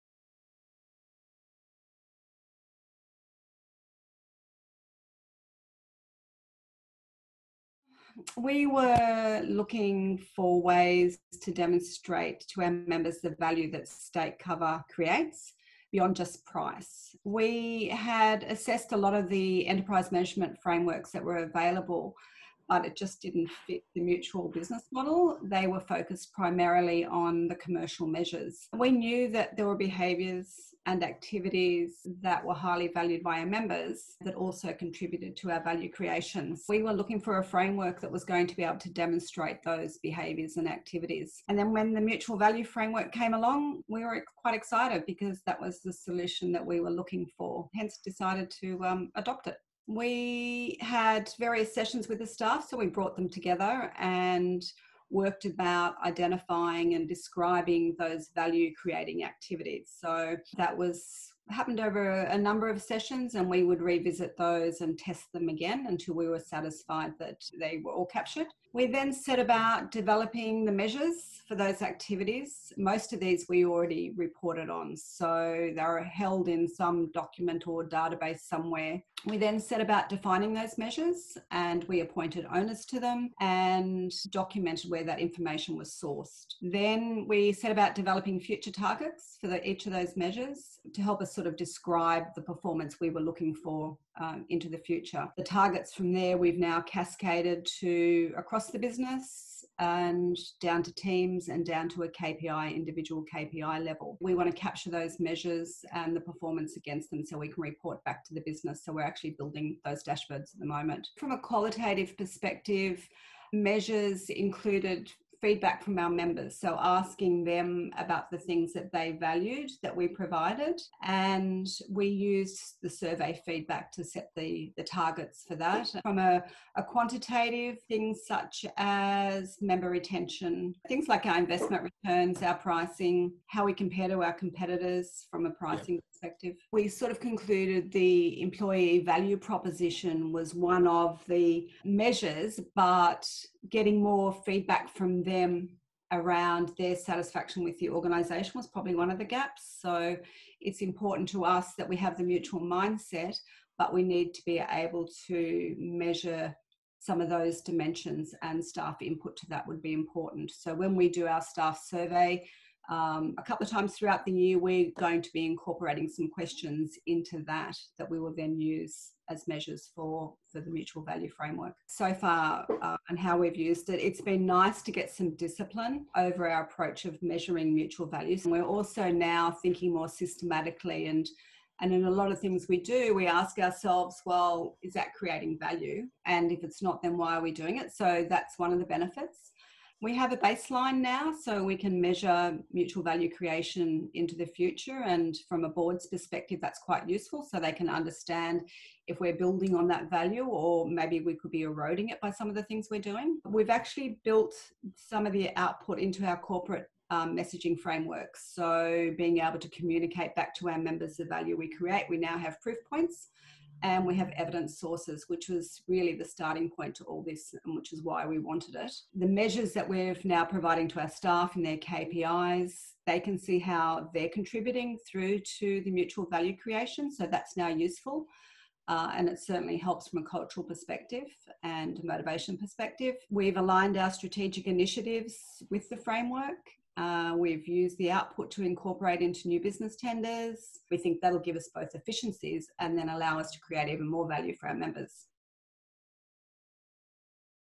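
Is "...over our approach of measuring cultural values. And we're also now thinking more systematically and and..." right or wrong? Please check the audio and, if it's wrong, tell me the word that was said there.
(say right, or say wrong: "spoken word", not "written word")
wrong: "mutual", not "cultural".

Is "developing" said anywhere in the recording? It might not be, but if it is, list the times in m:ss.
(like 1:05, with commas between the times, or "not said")
1:09, 1:27.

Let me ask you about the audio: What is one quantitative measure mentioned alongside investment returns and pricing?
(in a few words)
member retention.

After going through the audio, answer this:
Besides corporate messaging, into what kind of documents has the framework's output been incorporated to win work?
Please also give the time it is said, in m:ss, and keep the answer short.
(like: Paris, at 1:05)
new business tenders, at 3:59.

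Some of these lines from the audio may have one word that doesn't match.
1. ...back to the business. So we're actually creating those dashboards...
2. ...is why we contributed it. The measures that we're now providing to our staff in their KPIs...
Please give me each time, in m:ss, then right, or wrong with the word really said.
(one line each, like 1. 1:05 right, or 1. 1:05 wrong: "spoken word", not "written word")
1. 1:48 wrong: "building", not "creating"
2. 3:37 wrong: "wanted", not "contributed".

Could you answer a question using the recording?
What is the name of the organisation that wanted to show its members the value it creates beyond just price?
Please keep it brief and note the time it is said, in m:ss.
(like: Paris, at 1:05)
StateCover, at 0:13.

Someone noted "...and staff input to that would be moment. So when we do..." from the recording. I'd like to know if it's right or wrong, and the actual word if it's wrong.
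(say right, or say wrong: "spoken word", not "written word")
wrong: "important", not "moment".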